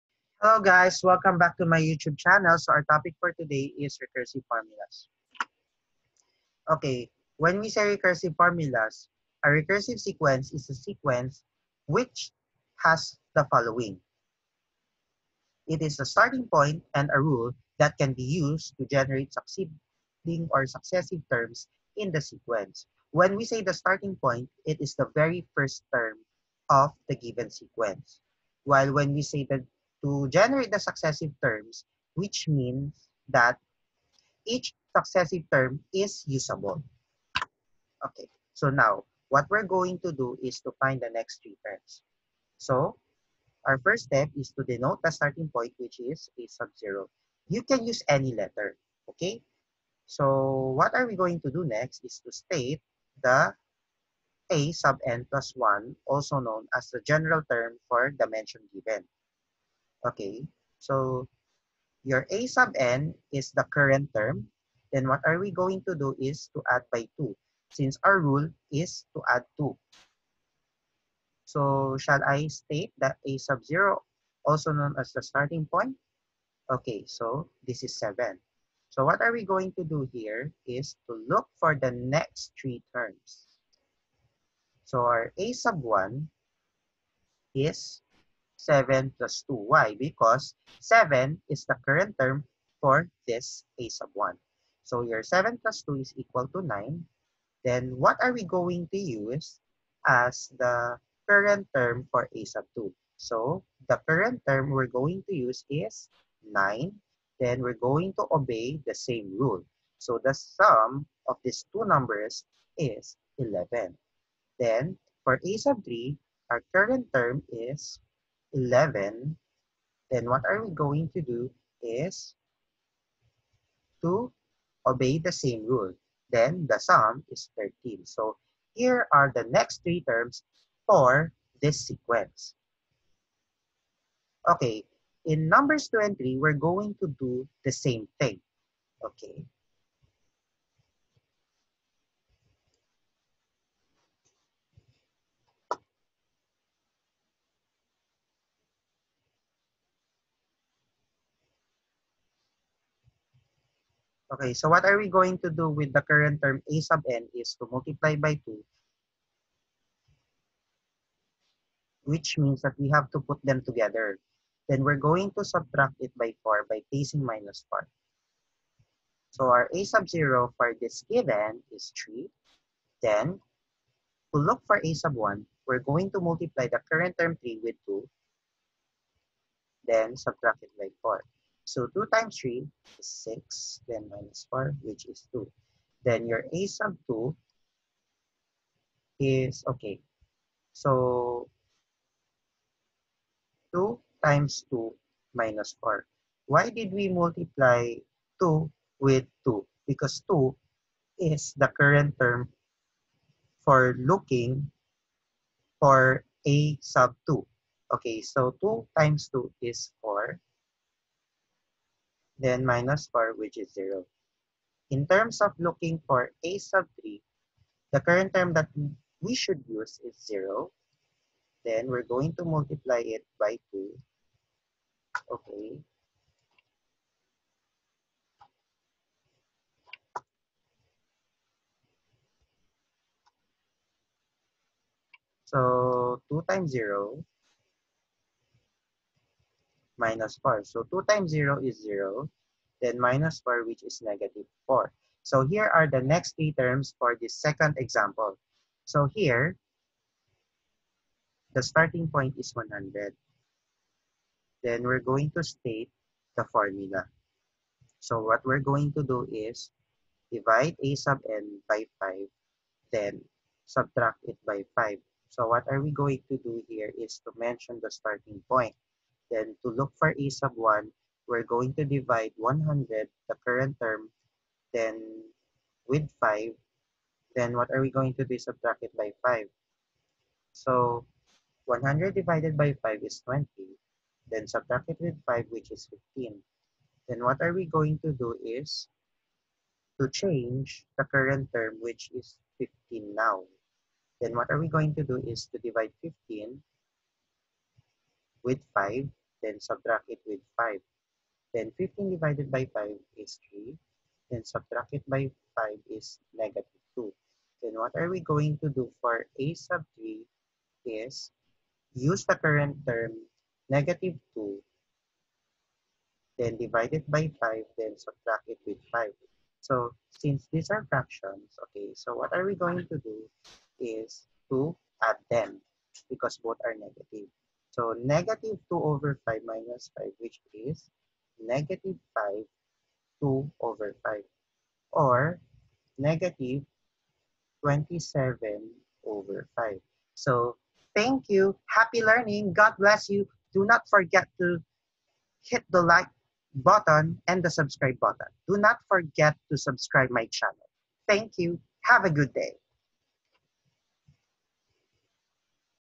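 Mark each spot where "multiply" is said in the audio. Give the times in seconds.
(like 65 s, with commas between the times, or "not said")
157 s, 176 s, 197 s, 222 s.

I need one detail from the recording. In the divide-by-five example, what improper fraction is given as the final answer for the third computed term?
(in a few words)
-27/5.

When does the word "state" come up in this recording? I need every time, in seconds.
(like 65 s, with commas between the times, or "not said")
52 s, 72 s, 255 s.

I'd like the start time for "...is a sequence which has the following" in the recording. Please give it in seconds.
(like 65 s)
10 s.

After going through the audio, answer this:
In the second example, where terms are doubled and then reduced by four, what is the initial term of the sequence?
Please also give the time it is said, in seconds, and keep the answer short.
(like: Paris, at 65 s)
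3, at 171 s.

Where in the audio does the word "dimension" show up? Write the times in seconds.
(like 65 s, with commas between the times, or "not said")
58 s.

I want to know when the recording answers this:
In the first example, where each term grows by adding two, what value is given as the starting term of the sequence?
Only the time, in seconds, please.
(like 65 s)
77 s.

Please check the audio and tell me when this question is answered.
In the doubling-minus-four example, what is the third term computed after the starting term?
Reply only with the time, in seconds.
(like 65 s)
244 s.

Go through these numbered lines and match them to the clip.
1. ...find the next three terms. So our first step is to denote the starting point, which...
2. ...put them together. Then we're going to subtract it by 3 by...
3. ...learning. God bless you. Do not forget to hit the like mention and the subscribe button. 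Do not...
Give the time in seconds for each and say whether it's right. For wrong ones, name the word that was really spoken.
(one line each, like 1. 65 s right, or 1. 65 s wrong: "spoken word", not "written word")
1. 40 s right
2. 163 s wrong: "4", not "3"
3. 342 s wrong: "button", not "mention".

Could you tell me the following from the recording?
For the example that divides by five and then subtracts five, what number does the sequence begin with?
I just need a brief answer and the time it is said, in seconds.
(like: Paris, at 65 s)
100, at 251 s.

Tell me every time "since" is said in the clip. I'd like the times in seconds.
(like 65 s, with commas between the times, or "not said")
67 s, 320 s.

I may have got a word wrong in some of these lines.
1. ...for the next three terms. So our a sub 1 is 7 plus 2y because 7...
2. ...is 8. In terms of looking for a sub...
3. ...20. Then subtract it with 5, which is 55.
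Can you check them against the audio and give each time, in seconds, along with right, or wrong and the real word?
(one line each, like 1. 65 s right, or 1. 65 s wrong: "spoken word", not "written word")
1. 81 s right
2. 213 s wrong: "0", not "8"
3. 283 s wrong: "15", not "55".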